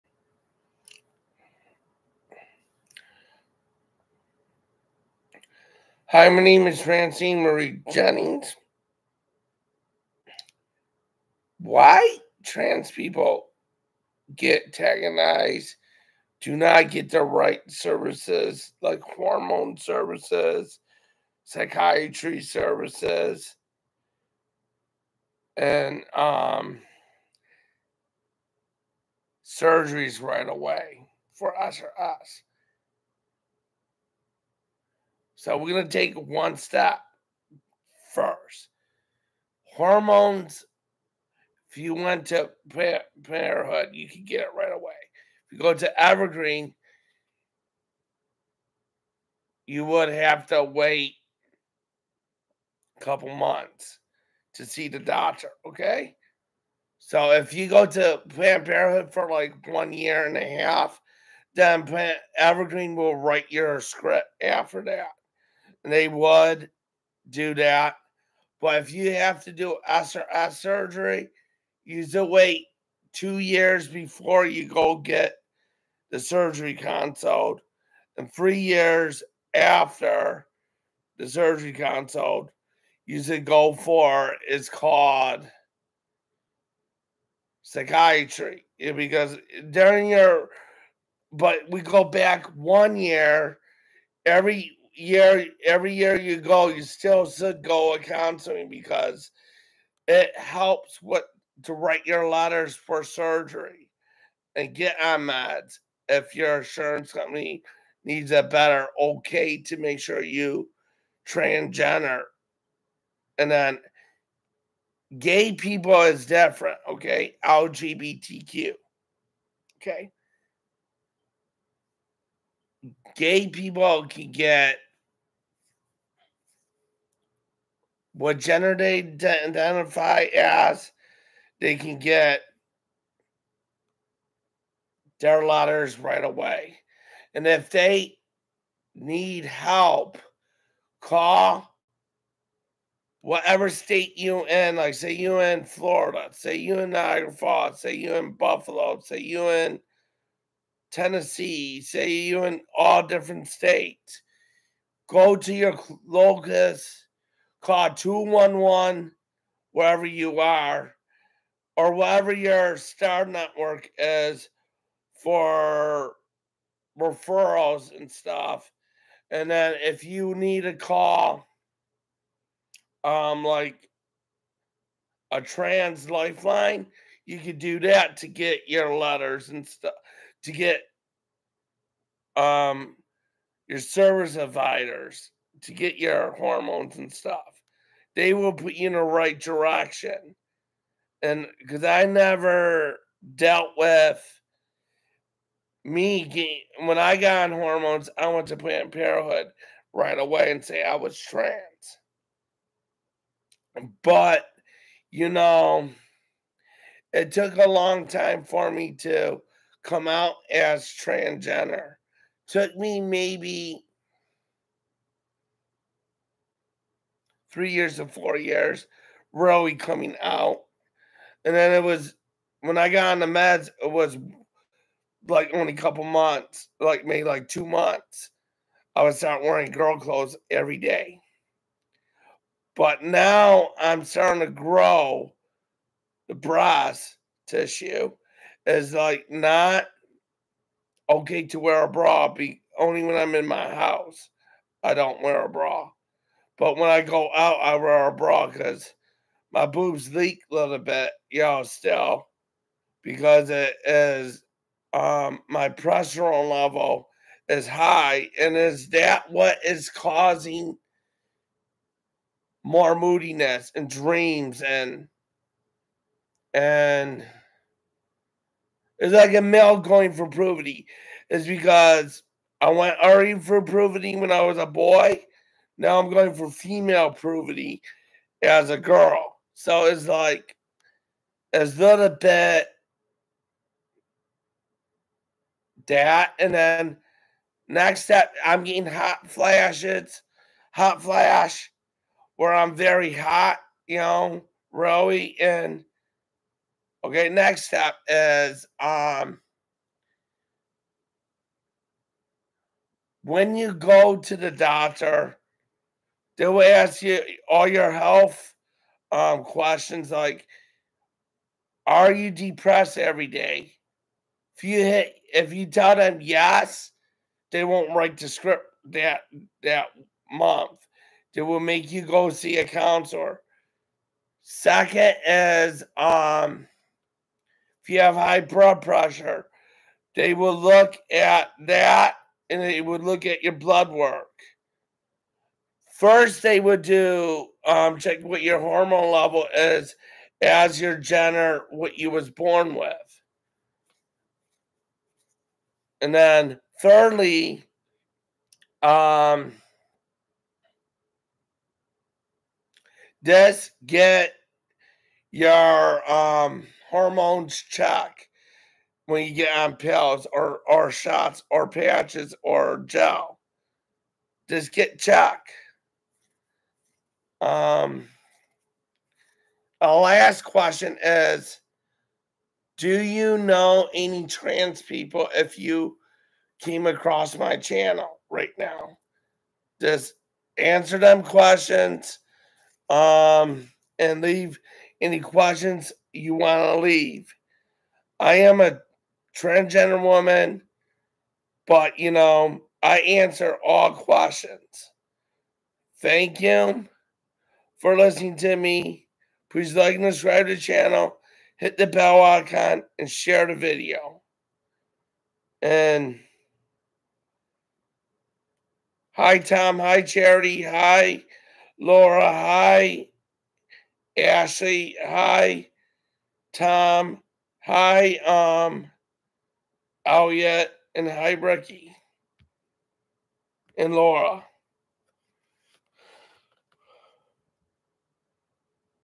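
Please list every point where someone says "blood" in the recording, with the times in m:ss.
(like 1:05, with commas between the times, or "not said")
5:28, 5:33.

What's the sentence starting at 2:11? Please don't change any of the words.
They can get their letters right away.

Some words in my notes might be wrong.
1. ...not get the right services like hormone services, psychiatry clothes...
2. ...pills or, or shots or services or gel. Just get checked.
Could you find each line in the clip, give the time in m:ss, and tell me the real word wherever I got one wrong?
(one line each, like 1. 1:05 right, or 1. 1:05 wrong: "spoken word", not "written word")
1. 0:16 wrong: "services", not "clothes"
2. 5:59 wrong: "patches", not "services".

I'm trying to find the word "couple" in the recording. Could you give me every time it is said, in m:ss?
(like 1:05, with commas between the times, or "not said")
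0:53, 3:45.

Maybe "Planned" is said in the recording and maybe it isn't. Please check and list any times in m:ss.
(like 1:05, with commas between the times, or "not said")
0:58, 3:18.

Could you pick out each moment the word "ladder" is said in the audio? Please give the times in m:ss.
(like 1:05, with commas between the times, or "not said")
not said.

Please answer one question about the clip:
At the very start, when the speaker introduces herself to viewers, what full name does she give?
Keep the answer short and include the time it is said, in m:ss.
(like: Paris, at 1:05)
Francine Marie Jennings, at 0:06.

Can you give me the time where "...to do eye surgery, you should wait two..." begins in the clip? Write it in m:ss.
1:09.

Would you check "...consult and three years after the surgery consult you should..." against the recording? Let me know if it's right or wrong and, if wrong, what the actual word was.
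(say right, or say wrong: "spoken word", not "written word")
right.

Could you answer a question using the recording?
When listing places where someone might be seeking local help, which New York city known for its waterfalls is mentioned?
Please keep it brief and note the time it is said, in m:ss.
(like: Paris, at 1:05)
Niagara Falls, at 2:26.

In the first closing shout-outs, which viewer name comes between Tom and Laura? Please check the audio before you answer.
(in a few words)
Charity.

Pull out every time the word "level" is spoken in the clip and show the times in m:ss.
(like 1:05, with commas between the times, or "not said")
4:16, 5:39.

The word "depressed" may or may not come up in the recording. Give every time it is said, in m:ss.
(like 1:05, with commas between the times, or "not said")
5:12.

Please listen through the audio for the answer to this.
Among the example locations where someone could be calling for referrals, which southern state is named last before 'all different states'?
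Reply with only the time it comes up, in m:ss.
2:30.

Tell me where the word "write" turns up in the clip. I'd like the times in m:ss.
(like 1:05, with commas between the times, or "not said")
1:03, 1:41, 5:17.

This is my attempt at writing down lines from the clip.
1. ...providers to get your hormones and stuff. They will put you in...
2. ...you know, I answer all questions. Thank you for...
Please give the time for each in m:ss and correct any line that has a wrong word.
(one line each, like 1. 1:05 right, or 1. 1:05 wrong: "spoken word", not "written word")
1. 3:04 right
2. 6:31 right.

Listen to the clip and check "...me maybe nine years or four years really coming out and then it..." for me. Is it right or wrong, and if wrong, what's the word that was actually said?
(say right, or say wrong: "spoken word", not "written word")
wrong: "three", not "nine".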